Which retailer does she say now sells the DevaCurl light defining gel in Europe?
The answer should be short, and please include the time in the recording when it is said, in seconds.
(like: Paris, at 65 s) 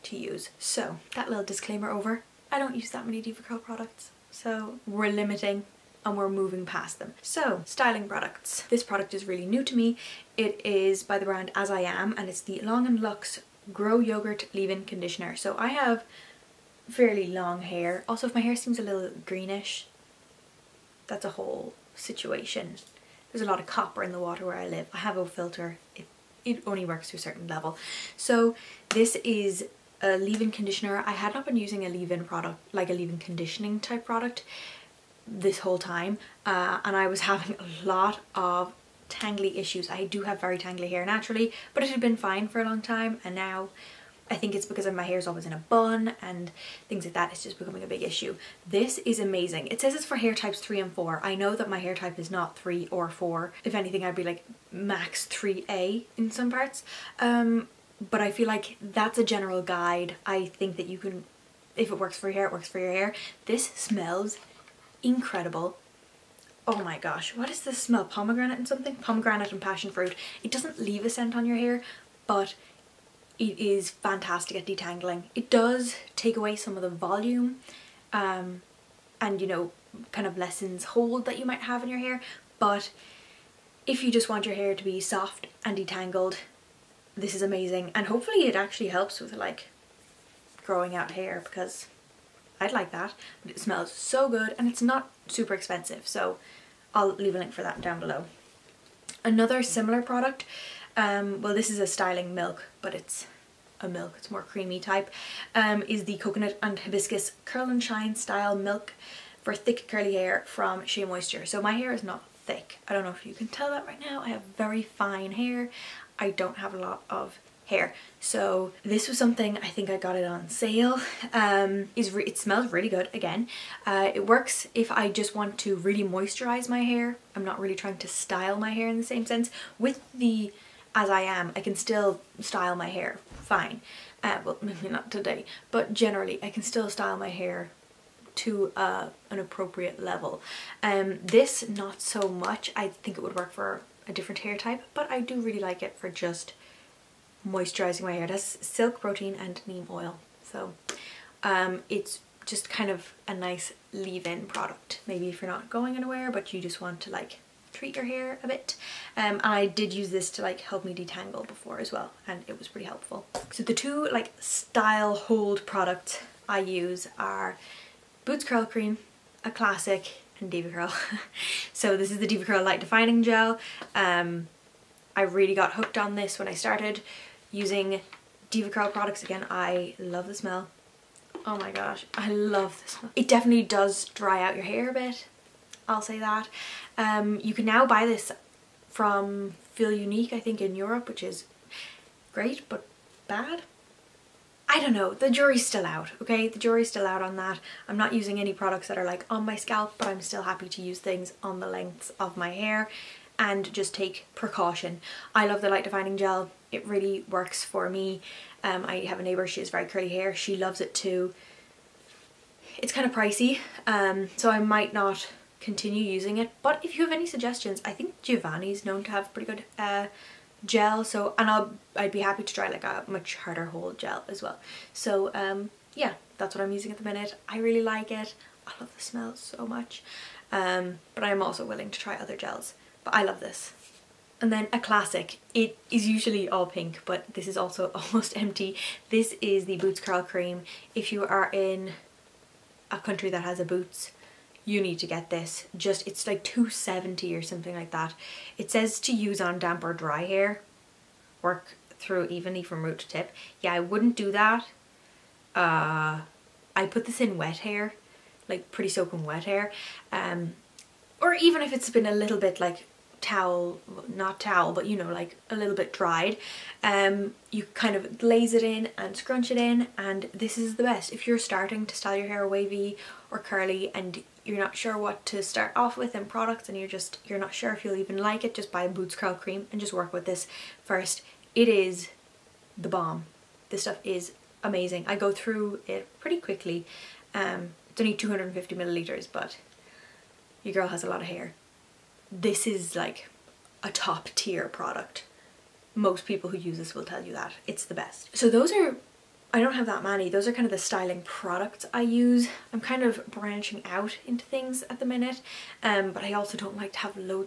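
Feel Unique, at 189 s.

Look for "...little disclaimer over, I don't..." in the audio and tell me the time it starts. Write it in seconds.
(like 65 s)
1 s.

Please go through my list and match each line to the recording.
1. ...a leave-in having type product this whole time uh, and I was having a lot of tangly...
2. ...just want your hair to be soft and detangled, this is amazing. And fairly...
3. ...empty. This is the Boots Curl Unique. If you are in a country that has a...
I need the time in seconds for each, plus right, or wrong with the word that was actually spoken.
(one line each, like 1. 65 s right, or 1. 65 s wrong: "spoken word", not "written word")
1. 32 s wrong: "conditioning", not "having"
2. 84 s wrong: "hopefully", not "fairly"
3. 238 s wrong: "Cream", not "Unique".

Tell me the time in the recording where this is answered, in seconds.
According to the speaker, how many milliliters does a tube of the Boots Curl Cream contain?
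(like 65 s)
288 s.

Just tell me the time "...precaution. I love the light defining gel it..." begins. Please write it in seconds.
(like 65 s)
204 s.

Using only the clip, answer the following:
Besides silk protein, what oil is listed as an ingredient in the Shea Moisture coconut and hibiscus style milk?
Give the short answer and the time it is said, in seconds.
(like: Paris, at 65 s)
Neem oil, at 149 s.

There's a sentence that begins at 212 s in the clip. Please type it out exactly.
It's kind of pricey, um, so I might not continue using it.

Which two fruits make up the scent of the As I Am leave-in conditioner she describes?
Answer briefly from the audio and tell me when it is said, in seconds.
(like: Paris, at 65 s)
Pomegranate and passion fruit, at 68 s.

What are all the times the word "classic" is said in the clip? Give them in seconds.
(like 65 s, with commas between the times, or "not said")
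169 s, 234 s.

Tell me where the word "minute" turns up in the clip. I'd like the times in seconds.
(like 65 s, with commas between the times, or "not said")
227 s, 305 s.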